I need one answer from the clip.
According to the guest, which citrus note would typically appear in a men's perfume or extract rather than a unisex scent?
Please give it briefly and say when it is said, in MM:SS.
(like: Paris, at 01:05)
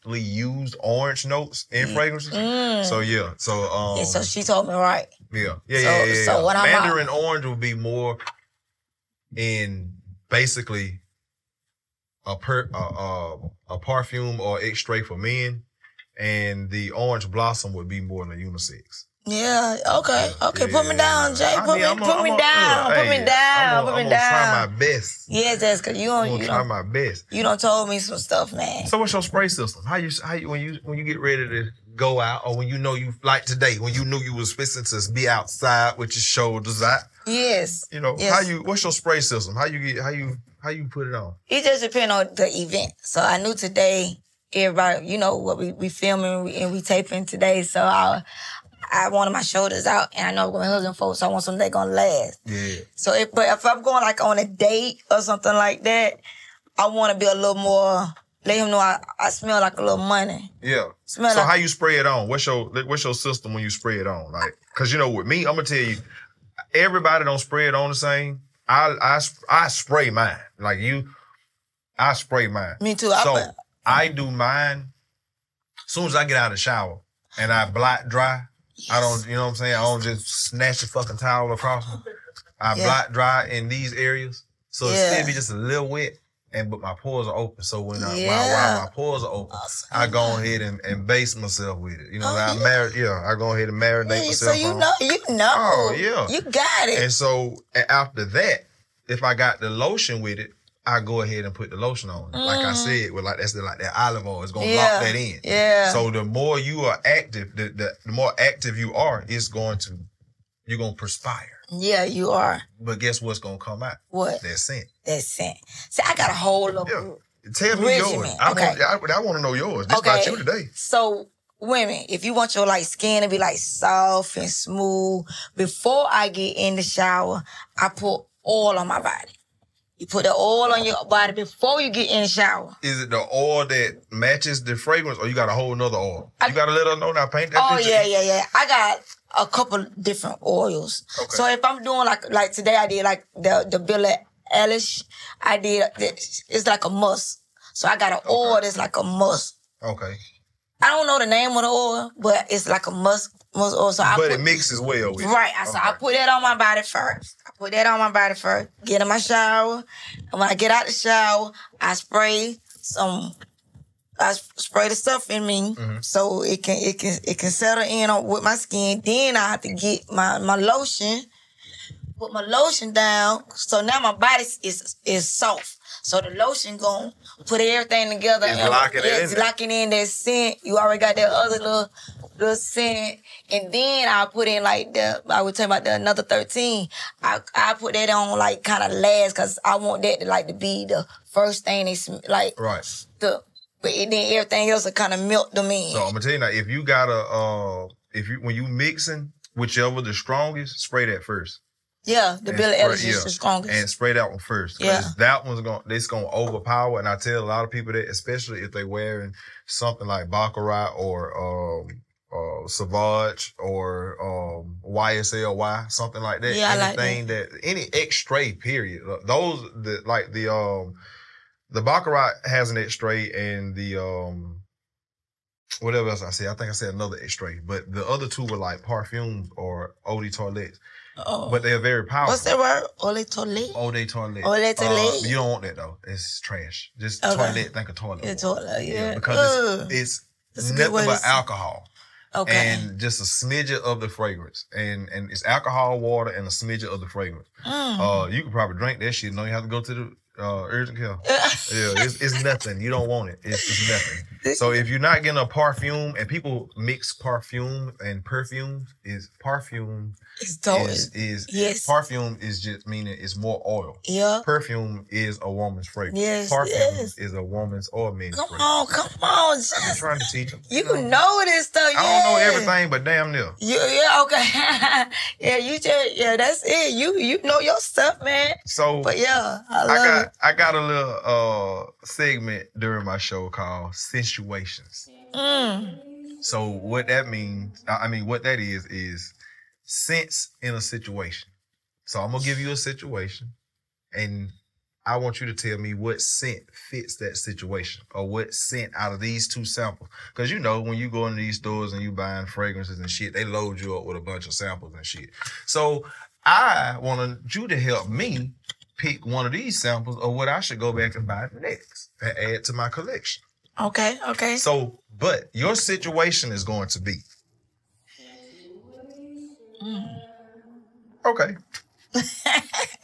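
Mandarin Orange, at 00:06.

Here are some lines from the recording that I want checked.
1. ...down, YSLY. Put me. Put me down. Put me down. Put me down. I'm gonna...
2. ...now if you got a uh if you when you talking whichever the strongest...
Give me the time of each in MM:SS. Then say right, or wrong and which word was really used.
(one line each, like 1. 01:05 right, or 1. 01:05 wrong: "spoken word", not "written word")
1. 00:20 wrong: "Jay", not "YSLY"
2. 03:16 wrong: "mixing", not "talking".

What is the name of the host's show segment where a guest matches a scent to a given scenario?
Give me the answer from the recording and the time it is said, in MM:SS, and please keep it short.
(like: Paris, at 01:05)
Situations, at 04:43.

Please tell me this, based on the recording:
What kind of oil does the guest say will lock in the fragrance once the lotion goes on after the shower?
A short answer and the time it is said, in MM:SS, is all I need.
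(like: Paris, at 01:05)
olive oil, at 01:43.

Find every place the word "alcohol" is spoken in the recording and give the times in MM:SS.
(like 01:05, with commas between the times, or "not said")
04:01, 04:05.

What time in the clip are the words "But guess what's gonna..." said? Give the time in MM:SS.
01:52.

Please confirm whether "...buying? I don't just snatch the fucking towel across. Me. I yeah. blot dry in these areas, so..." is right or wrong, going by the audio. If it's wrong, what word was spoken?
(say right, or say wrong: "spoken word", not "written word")
wrong: "saying", not "buying".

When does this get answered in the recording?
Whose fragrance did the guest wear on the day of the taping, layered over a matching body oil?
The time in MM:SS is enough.
02:23.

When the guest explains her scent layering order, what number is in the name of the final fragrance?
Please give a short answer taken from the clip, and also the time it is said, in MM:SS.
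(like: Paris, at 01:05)
13, at 03:06.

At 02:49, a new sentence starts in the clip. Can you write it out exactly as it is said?
Then I have to get my my lotion, put my lotion down.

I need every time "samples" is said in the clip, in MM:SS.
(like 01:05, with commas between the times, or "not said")
04:59, 05:04, 05:09.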